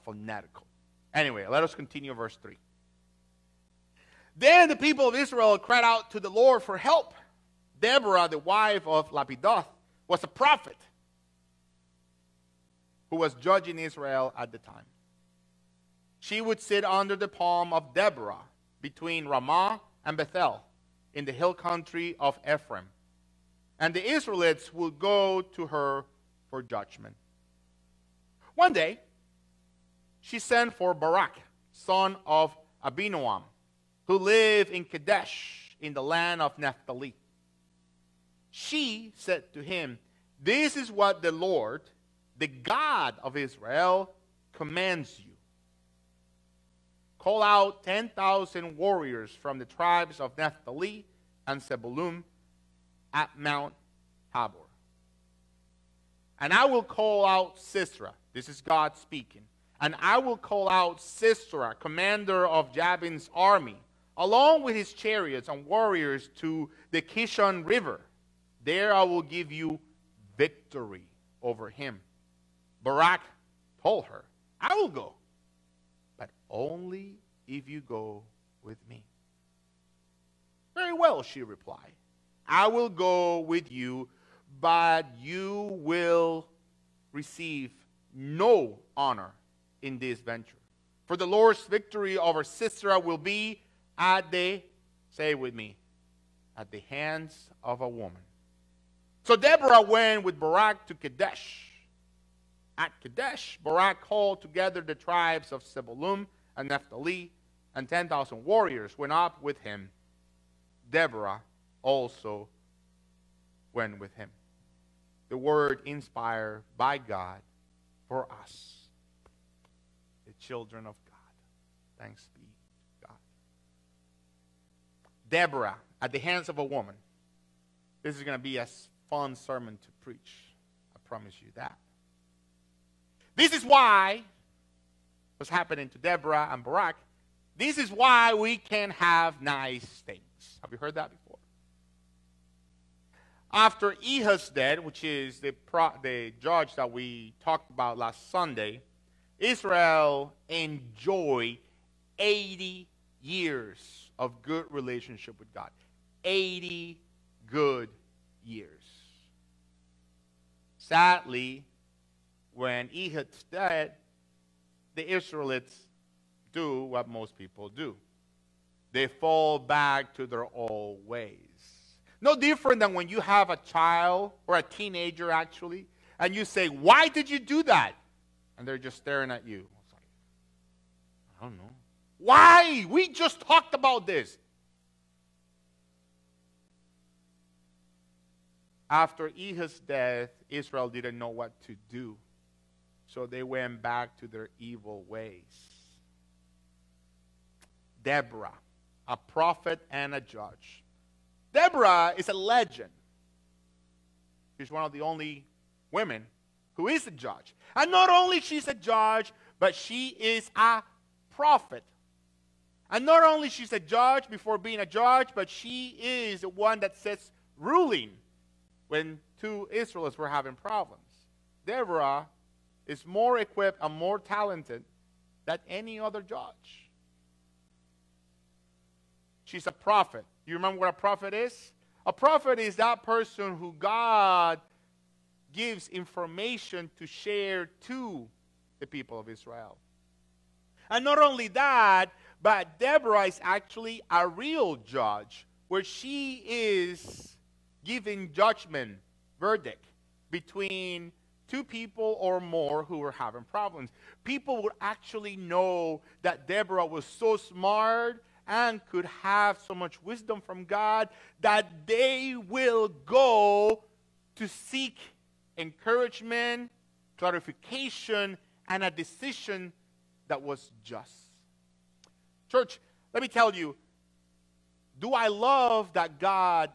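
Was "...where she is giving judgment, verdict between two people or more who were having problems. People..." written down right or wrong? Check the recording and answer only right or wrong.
right.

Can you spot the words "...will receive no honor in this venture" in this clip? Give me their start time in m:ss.
1:25.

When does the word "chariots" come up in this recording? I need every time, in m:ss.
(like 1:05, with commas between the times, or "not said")
1:04.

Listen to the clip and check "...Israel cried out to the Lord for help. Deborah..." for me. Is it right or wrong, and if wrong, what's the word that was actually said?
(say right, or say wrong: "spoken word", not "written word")
right.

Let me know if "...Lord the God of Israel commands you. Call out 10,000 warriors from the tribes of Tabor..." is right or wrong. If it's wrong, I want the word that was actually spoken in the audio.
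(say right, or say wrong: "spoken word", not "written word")
wrong: "Naphtali", not "Tabor".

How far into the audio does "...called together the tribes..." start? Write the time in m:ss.
1:44.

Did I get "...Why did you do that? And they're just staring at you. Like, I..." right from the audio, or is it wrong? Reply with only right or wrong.
right.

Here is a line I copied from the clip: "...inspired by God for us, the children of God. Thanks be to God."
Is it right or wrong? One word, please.
right.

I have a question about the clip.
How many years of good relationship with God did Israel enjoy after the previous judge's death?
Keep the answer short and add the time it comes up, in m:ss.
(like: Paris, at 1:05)
80, at 2:32.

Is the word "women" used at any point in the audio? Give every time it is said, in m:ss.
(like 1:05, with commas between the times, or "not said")
3:25.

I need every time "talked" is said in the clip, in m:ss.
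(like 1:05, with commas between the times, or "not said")
2:27, 3:03.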